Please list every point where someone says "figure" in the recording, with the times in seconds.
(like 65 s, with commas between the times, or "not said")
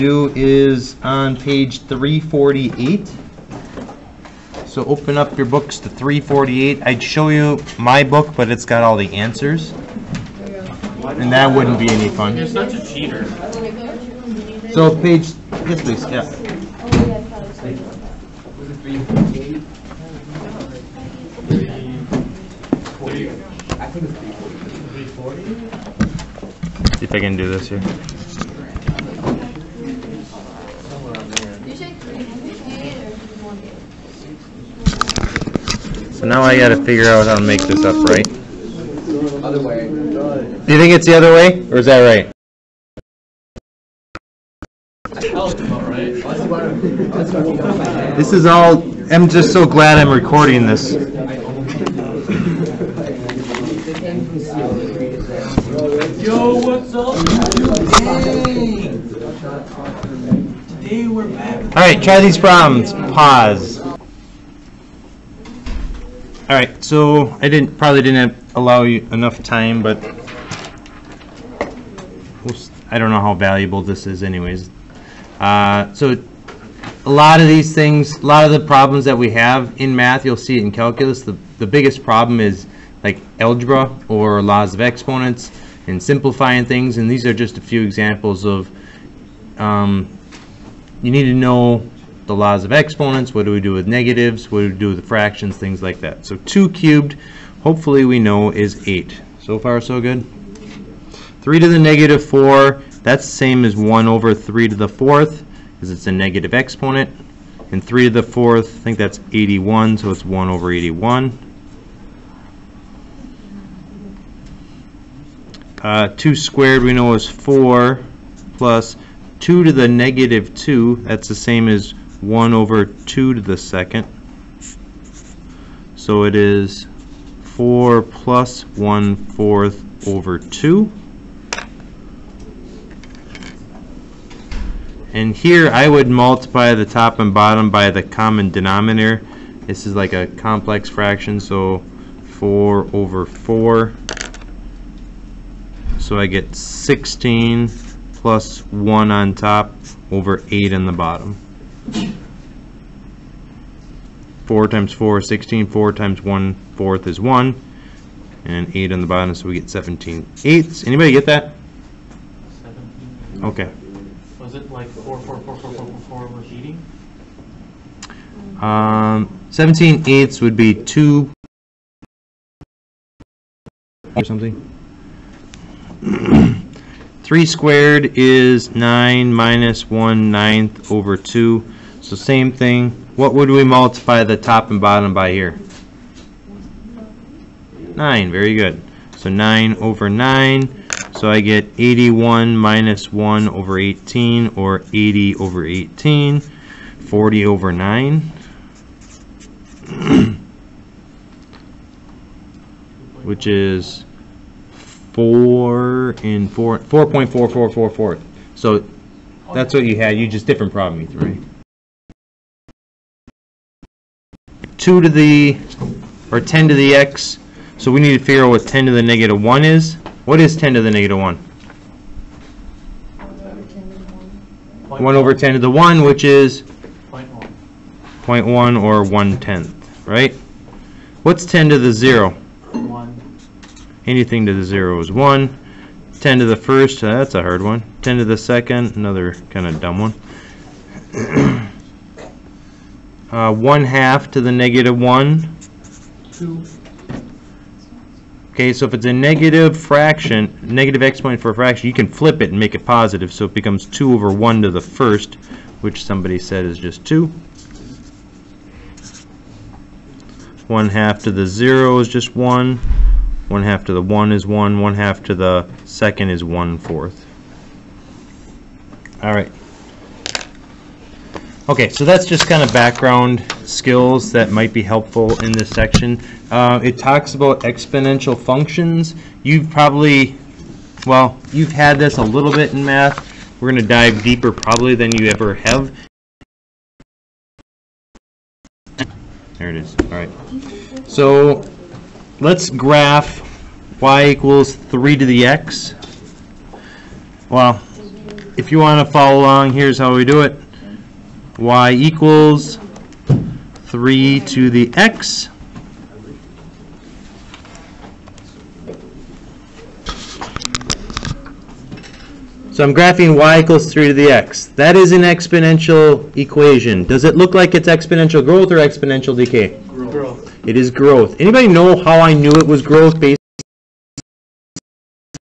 36 s, 218 s.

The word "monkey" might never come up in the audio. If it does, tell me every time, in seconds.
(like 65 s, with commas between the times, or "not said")
not said.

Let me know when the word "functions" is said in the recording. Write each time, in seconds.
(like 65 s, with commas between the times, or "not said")
278 s.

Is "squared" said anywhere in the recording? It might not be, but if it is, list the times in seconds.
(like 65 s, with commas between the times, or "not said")
116 s, 177 s.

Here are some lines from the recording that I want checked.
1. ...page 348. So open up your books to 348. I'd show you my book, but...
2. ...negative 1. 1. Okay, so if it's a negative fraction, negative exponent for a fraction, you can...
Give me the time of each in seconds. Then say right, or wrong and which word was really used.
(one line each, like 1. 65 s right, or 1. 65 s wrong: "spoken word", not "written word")
1. 1 s right
2. 244 s wrong: "2", not "1".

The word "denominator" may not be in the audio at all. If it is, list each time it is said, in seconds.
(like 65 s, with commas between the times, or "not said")
138 s.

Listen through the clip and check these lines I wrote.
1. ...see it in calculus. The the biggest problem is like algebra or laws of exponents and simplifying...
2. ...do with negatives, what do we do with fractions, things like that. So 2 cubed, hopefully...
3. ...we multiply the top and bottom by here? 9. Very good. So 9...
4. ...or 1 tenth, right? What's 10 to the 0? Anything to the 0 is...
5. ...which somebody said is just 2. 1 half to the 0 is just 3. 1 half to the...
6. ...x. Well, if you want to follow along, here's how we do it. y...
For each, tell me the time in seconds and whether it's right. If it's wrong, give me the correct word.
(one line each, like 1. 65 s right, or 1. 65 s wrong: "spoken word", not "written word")
1. 80 s right
2. 93 s right
3. 183 s right
4. 228 s right
5. 255 s wrong: "1", not "3"
6. 295 s right.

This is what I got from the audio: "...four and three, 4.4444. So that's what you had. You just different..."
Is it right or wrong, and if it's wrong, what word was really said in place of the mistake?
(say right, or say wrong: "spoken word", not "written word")
wrong: "four", not "three".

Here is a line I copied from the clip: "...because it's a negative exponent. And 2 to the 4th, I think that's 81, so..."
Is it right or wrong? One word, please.
wrong.